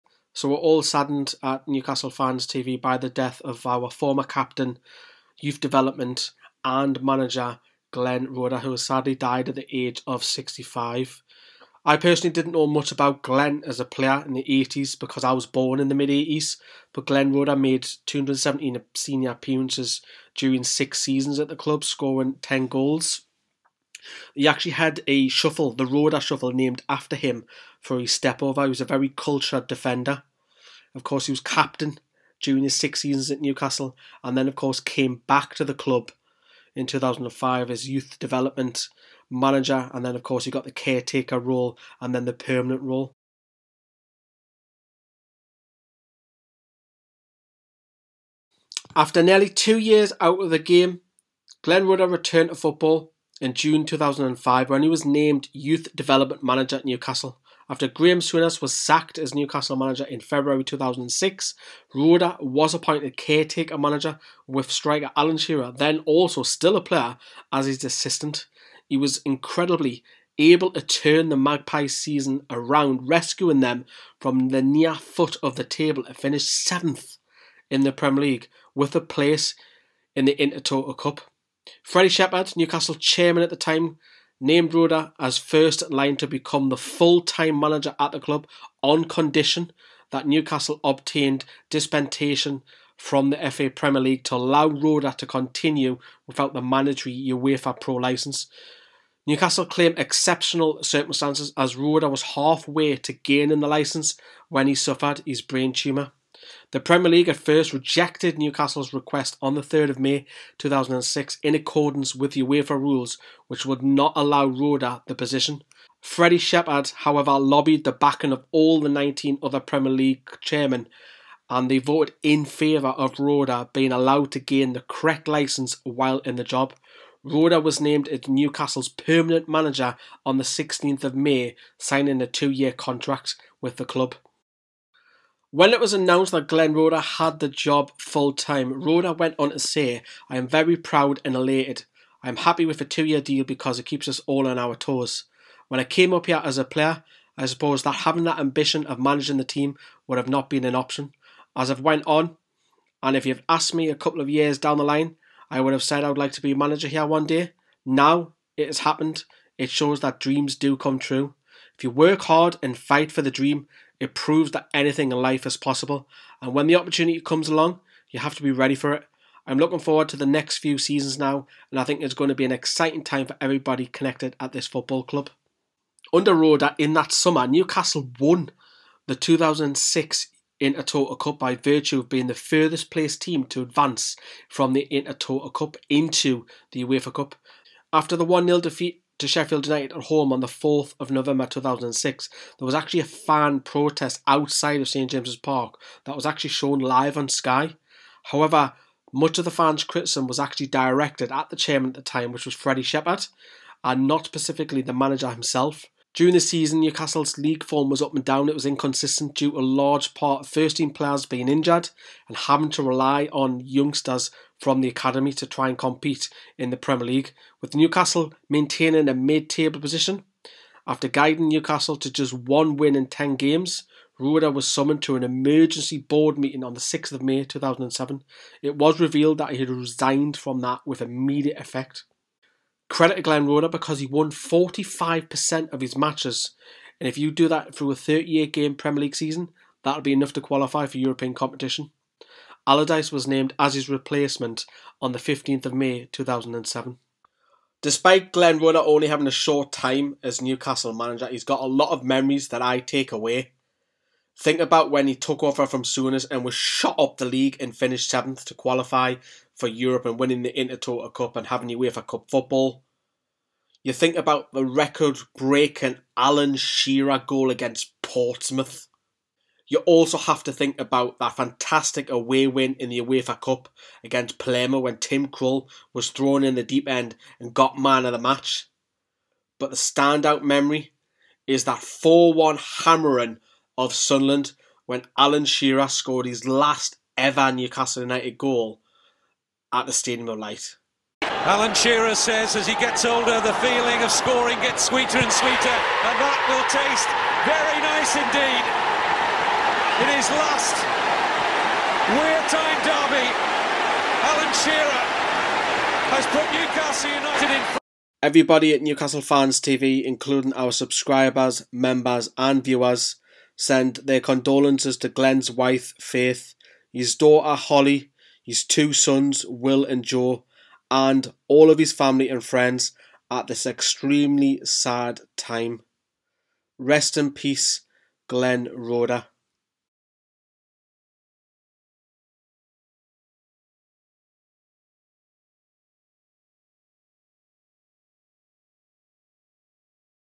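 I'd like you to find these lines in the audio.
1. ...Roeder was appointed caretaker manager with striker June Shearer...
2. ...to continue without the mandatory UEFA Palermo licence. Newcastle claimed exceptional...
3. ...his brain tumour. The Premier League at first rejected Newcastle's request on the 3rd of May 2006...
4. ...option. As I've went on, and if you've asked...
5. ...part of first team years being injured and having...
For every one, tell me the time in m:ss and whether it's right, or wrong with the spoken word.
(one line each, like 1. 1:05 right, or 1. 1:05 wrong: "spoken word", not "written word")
1. 1:01 wrong: "Alan", not "June"
2. 1:35 wrong: "Pro", not "Palermo"
3. 1:45 right
4. 2:30 right
5. 3:30 wrong: "players", not "years".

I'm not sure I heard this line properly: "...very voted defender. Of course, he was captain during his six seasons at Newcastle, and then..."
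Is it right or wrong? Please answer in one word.
wrong.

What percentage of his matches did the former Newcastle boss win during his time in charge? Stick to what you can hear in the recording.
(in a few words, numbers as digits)
45%.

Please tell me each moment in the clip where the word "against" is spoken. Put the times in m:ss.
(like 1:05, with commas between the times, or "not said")
4:27, 4:34.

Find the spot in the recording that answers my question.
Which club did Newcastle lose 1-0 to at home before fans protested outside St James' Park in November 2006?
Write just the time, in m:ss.
3:09.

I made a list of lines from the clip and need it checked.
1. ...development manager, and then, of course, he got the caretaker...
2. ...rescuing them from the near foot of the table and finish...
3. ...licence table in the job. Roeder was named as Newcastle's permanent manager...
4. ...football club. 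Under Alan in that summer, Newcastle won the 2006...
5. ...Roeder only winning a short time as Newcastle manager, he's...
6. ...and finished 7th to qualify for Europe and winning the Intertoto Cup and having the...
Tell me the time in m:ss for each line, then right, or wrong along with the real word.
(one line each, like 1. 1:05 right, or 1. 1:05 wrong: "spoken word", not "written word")
1. 0:38 right
2. 1:13 right
3. 2:05 wrong: "while", not "table"
4. 2:54 wrong: "Roeder", not "Alan"
5. 4:08 wrong: "having", not "winning"
6. 4:17 right.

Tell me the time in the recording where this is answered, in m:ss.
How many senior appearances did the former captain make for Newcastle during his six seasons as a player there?
0:18.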